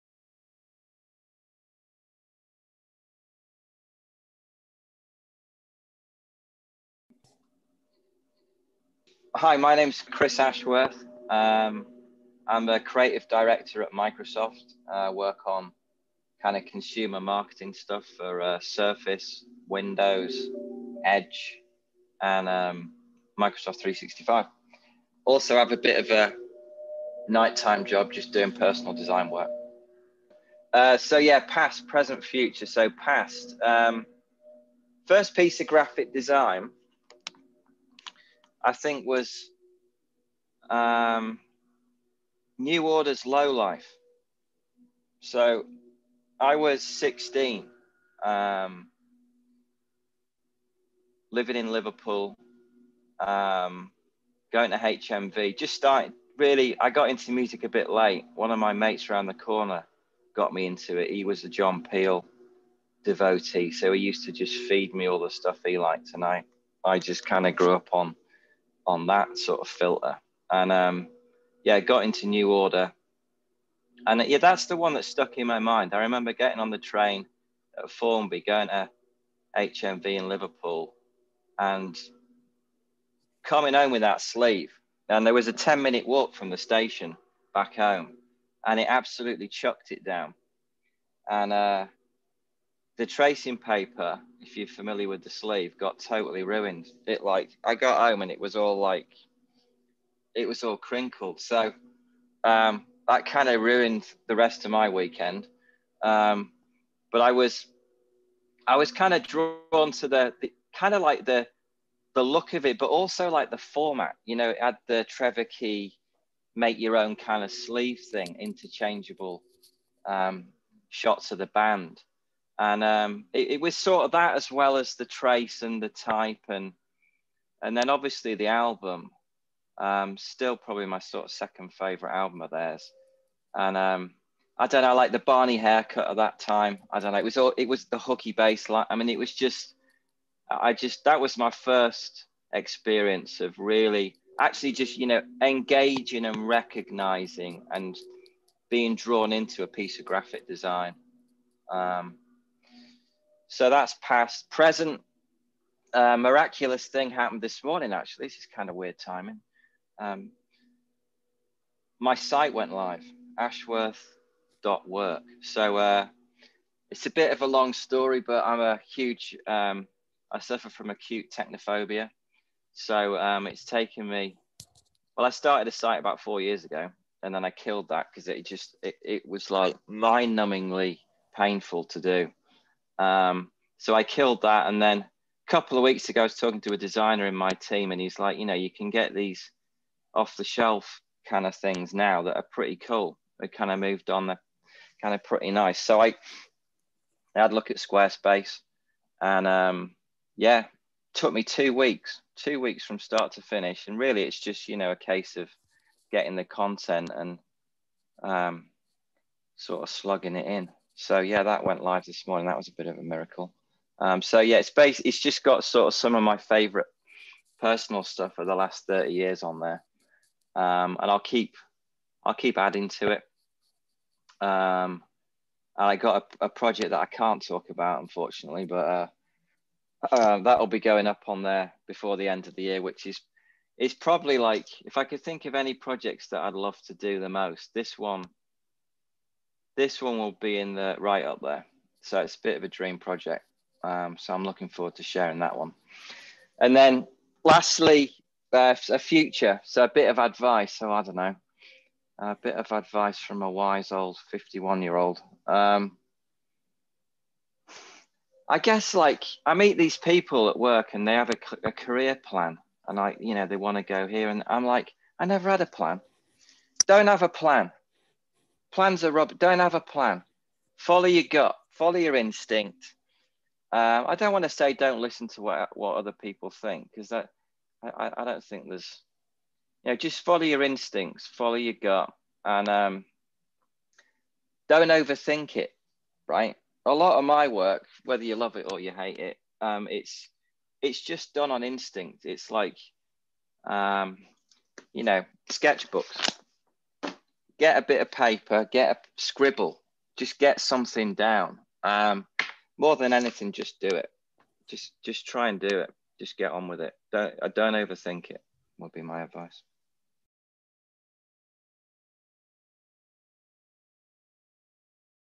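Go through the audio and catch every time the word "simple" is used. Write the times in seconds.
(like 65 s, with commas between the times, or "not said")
not said.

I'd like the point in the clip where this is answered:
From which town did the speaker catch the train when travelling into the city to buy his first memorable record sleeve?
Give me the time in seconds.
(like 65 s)
77 s.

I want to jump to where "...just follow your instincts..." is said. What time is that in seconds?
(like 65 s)
279 s.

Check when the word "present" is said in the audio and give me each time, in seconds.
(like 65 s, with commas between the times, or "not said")
31 s, 154 s.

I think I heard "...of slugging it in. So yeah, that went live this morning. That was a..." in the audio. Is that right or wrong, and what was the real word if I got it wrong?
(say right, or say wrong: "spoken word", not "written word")
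right.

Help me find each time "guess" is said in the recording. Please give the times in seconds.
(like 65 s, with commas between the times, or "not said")
258 s.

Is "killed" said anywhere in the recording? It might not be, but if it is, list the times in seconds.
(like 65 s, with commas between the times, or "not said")
177 s, 184 s.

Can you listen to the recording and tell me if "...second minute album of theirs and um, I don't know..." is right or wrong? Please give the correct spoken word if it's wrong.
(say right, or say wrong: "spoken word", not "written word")
wrong: "favorite", not "minute".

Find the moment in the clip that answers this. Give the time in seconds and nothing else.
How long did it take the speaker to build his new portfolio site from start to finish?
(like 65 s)
202 s.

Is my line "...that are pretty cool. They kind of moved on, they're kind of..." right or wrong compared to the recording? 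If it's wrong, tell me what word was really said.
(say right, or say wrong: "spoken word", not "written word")
right.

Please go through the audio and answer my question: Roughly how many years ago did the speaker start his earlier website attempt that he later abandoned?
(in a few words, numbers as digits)
4 years.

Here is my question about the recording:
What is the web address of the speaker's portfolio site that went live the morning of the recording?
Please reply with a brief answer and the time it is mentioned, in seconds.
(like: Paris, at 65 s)
ashworth.work, at 163 s.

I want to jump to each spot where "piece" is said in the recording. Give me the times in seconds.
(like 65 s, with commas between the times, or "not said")
35 s, 149 s.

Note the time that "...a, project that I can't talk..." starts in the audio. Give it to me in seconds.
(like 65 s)
226 s.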